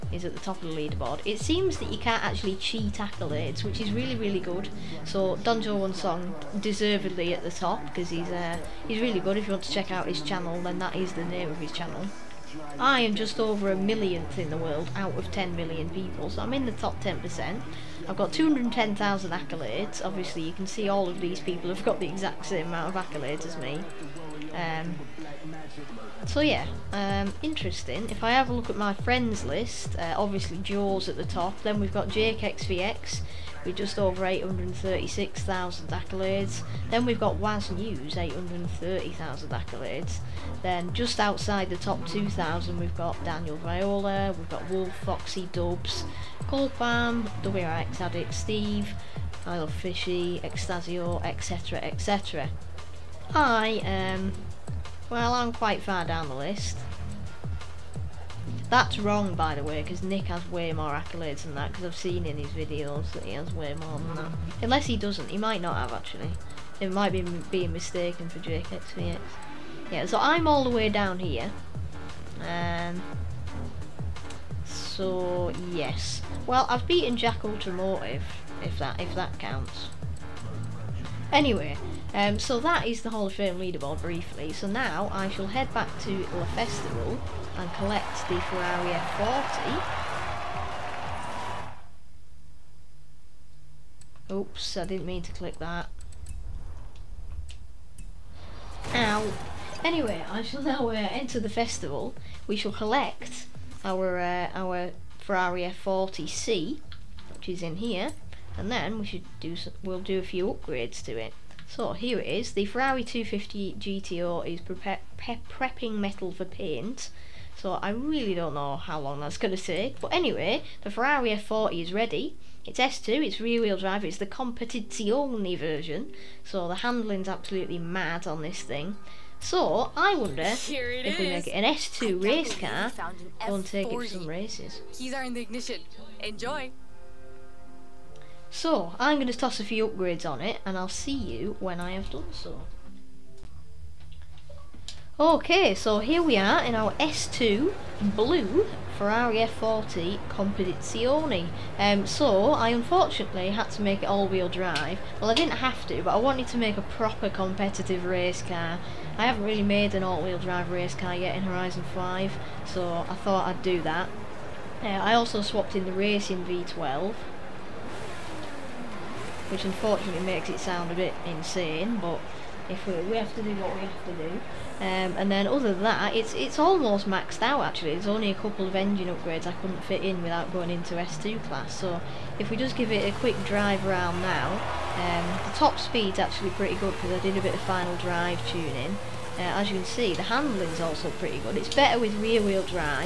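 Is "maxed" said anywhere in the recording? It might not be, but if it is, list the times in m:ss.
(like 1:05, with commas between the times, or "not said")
2:57.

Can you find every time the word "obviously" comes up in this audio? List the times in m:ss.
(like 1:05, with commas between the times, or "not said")
0:20, 0:30.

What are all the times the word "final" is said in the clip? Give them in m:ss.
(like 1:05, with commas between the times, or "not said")
3:07.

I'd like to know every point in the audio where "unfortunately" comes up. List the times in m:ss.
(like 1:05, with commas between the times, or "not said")
2:32, 2:49.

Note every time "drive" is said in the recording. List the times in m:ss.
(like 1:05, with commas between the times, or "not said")
2:03, 2:34, 2:40, 3:03, 3:07.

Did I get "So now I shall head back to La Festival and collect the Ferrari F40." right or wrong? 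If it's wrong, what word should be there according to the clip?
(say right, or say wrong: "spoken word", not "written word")
right.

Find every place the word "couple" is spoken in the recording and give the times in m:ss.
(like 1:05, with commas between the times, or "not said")
2:58.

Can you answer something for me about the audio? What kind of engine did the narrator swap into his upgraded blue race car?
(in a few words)
racing V12.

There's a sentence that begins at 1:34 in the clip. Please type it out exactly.
Oops, I didn't mean to click that.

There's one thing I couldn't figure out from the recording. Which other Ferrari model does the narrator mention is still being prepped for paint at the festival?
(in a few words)
Ferrari 250 GTO.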